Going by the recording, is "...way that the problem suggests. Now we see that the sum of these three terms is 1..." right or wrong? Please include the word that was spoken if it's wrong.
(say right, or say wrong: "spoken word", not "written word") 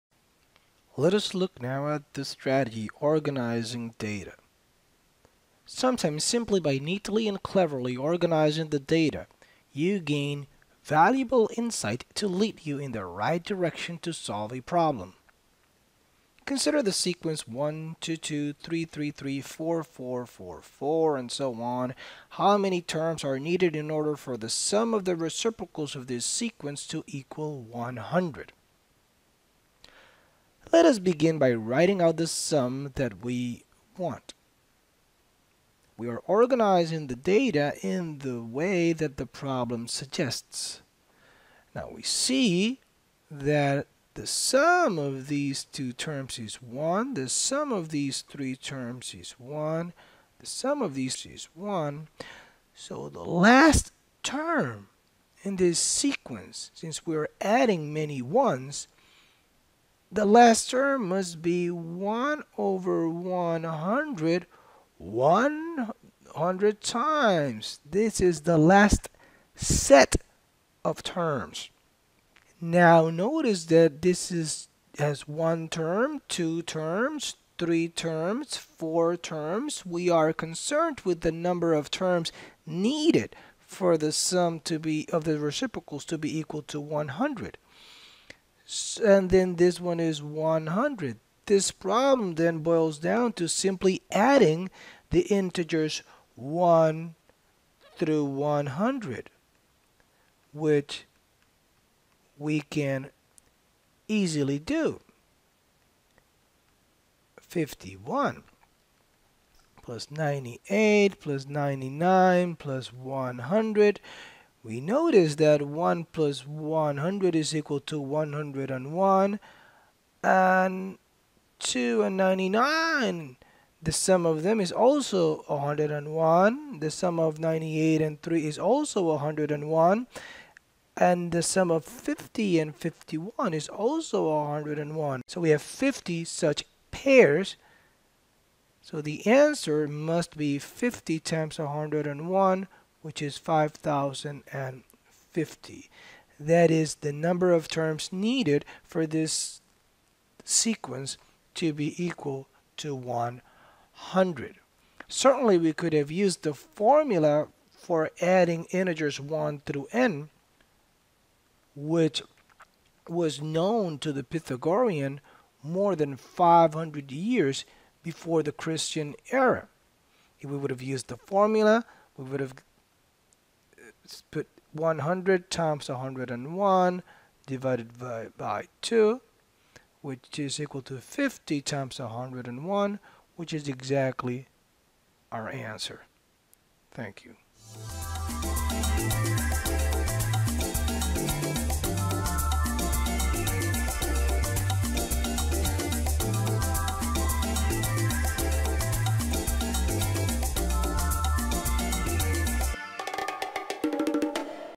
wrong: "two", not "three".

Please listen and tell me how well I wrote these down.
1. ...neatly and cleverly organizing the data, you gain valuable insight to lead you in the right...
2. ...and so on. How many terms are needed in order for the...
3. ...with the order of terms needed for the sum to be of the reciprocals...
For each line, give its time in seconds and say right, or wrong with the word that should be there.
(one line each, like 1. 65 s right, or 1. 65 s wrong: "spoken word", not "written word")
1. 6 s right
2. 21 s right
3. 81 s wrong: "number", not "order".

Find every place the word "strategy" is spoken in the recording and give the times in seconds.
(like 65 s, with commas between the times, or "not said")
2 s.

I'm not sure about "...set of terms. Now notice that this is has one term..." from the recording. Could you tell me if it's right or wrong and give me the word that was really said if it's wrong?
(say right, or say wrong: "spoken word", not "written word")
right.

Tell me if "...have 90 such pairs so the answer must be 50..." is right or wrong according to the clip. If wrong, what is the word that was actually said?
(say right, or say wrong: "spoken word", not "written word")
wrong: "50", not "90".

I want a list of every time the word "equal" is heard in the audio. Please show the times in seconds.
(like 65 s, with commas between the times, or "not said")
27 s, 86 s, 117 s, 152 s, 180 s.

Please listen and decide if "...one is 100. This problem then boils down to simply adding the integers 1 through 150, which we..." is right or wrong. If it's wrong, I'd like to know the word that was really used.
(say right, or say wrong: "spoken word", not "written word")
wrong: "100", not "150".